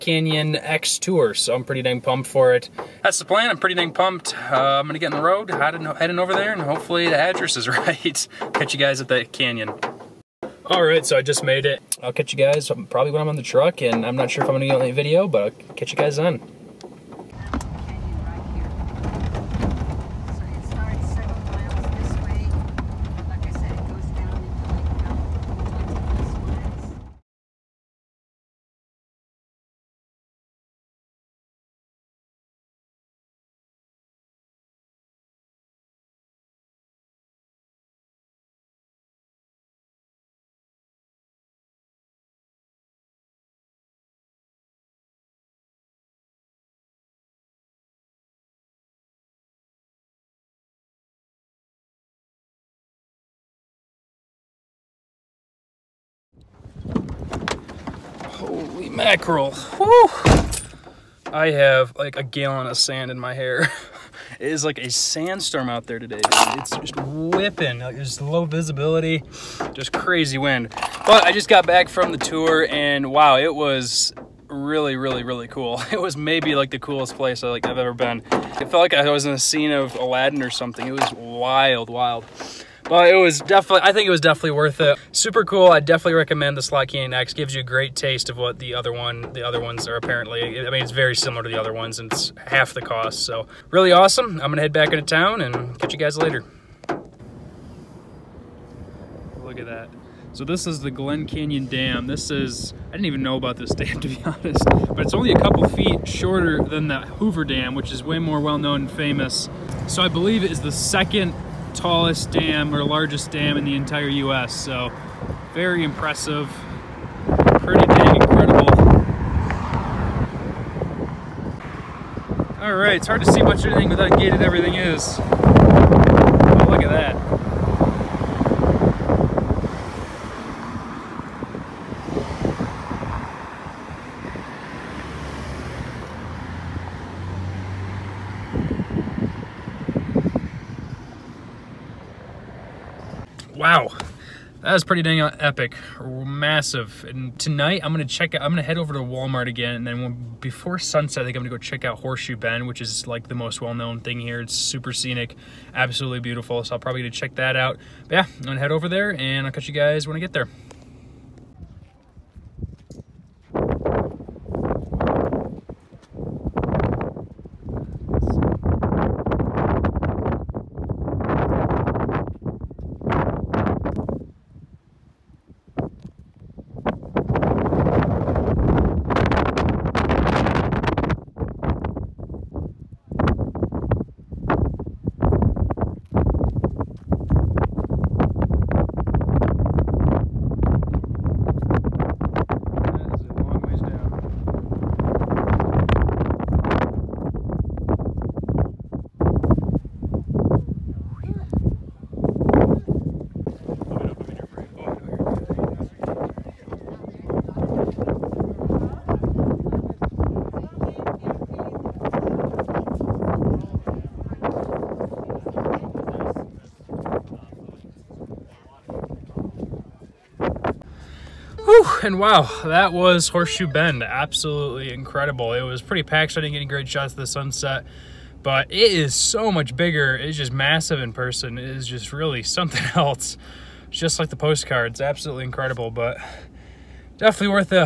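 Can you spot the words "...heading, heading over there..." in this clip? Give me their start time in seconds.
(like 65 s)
5 s.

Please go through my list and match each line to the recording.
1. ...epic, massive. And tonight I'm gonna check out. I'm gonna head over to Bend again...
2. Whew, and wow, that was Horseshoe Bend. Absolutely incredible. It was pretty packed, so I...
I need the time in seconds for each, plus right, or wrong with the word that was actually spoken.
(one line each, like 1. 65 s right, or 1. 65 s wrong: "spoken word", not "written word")
1. 145 s wrong: "Walmart", not "Bend"
2. 221 s right.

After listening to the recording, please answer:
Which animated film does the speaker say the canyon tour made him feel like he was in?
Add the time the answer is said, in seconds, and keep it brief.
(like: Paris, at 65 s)
Aladdin, at 79 s.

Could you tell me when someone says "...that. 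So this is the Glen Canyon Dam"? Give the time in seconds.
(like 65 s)
99 s.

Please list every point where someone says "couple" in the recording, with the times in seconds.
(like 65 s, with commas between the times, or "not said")
105 s.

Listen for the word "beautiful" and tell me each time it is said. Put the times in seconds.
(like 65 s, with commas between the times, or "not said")
156 s.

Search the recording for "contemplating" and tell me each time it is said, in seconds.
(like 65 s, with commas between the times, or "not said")
not said.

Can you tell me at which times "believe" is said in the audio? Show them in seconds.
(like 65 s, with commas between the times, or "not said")
110 s.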